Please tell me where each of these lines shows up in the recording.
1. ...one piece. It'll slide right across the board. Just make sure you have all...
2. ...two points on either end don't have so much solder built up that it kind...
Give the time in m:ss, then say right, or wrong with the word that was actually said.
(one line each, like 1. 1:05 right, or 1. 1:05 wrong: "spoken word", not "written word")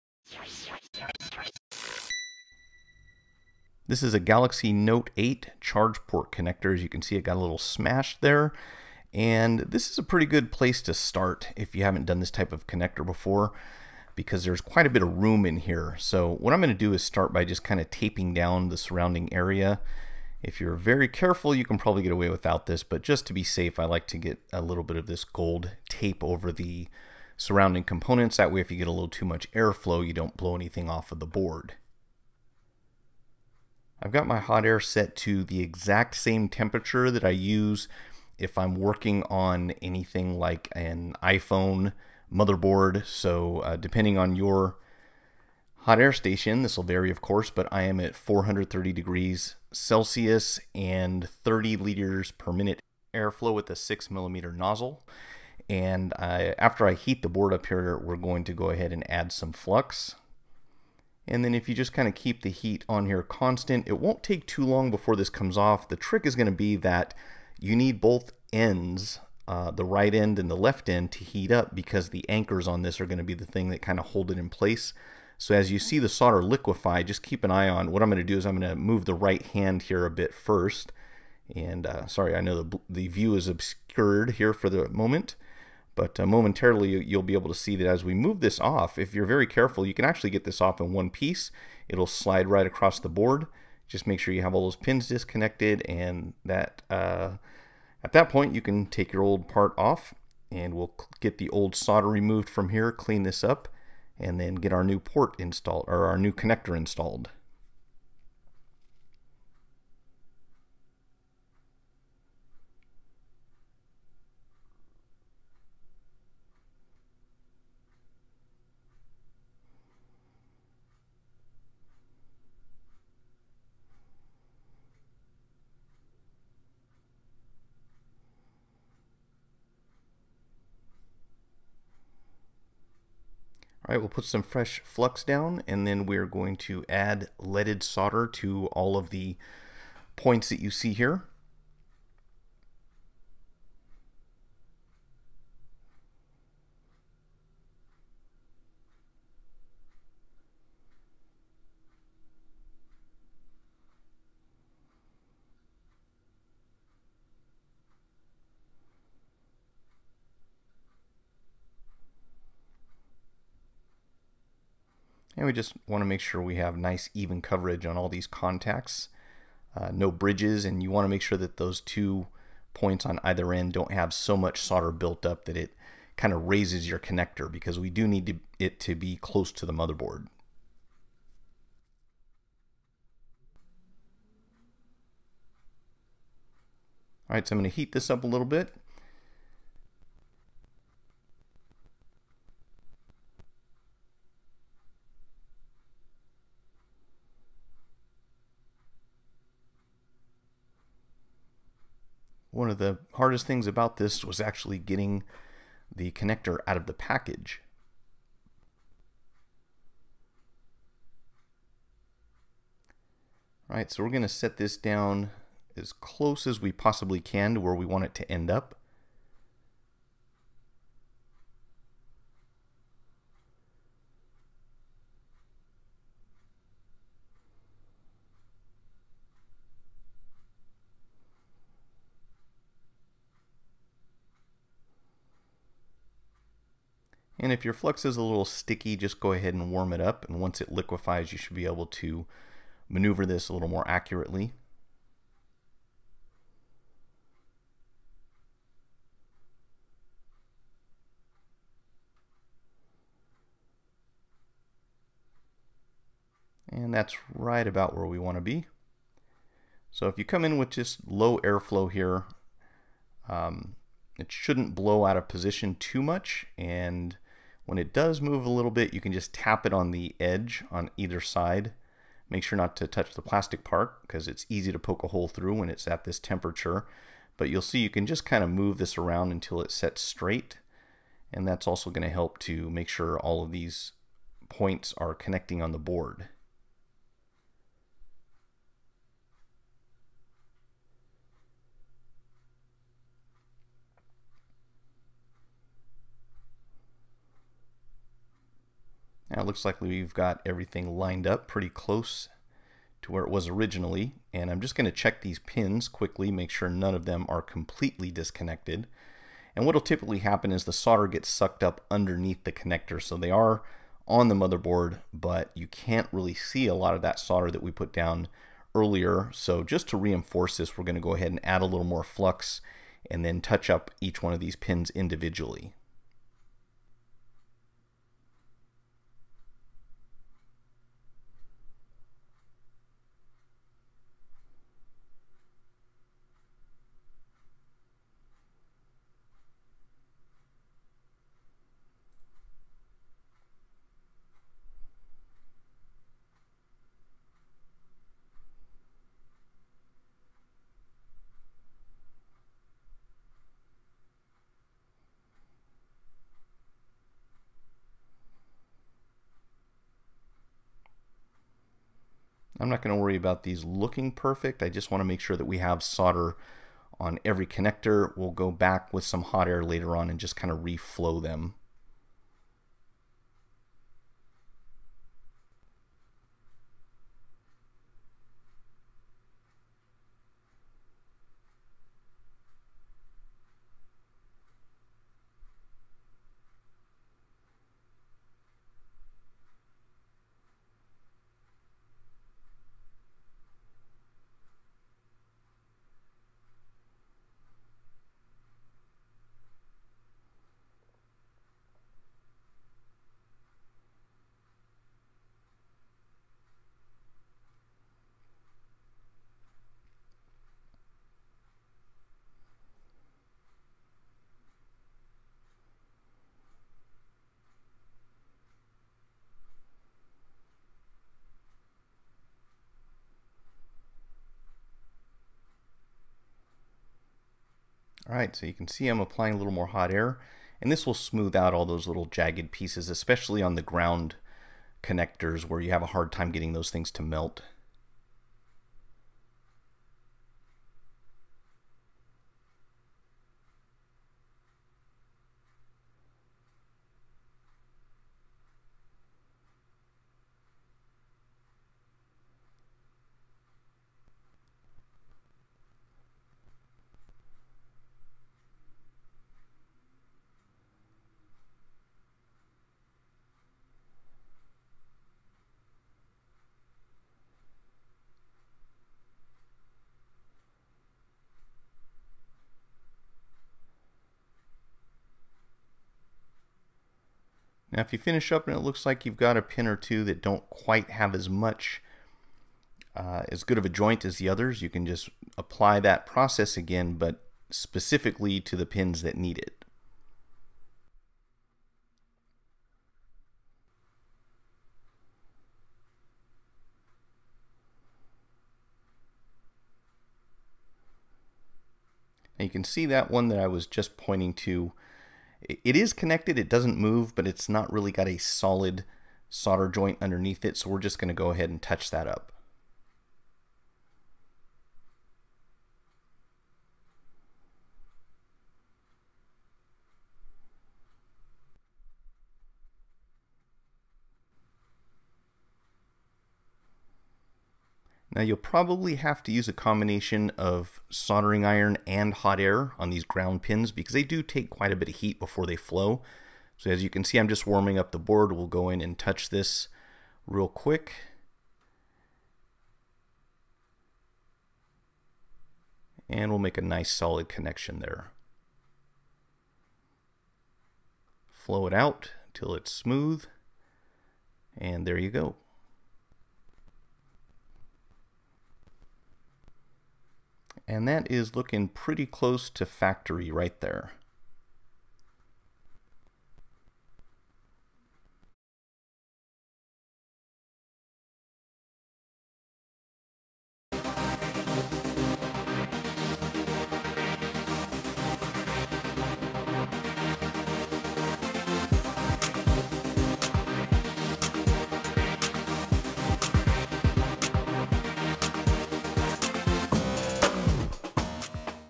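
1. 1:30 right
2. 2:51 right.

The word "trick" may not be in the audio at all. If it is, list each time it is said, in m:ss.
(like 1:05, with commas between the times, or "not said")
1:05.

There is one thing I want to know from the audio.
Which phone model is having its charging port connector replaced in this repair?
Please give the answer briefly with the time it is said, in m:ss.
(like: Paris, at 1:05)
Galaxy Note 8, at 0:04.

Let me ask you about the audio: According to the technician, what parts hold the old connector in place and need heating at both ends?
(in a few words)
the anchors.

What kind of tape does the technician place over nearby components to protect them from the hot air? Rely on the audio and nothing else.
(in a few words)
gold tape.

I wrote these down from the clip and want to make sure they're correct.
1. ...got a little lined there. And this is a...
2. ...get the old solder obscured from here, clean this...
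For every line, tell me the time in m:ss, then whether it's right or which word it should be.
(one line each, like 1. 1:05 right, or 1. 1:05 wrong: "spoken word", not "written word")
1. 0:07 wrong: "smashed", not "lined"
2. 1:41 wrong: "removed", not "obscured".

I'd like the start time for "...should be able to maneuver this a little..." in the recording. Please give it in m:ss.
4:01.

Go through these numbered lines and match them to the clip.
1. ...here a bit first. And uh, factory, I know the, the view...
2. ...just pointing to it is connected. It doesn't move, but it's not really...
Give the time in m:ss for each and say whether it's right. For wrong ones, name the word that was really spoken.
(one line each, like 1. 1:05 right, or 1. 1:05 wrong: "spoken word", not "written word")
1. 1:19 wrong: "sorry", not "factory"
2. 8:23 right.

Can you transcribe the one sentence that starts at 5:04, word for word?
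And I'm just going to check these pins quickly, make sure none of them are completely disconnected.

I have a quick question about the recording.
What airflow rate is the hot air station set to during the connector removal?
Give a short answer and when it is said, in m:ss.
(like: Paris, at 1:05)
30 liters per minute, at 0:51.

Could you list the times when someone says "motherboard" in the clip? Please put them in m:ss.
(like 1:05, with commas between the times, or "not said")
0:42, 2:59, 5:14.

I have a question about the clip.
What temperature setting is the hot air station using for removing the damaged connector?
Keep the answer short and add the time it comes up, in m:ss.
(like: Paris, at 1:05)
430 degrees Celsius, at 0:48.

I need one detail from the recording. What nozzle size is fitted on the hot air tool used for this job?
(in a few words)
6 millimeter.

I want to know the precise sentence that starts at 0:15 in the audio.
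So what I'm going to do is start by just kind of taping down the surrounding area.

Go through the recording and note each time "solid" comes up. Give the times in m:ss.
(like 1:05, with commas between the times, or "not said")
8:28, 9:06.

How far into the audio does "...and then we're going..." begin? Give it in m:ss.
2:15.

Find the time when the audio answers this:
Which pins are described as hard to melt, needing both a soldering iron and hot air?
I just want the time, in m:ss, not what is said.
8:53.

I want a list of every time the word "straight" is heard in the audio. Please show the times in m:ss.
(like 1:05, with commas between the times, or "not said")
4:40.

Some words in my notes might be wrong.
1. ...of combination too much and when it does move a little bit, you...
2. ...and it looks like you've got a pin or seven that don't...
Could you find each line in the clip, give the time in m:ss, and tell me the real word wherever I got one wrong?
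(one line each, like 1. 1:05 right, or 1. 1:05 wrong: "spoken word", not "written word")
1. 4:25 wrong: "position", not "combination"
2. 7:58 wrong: "two", not "seven".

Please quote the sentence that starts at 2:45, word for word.
And we just want to make sure we have nice even coverage on all these contacts.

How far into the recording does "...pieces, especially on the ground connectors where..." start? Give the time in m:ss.
7:12.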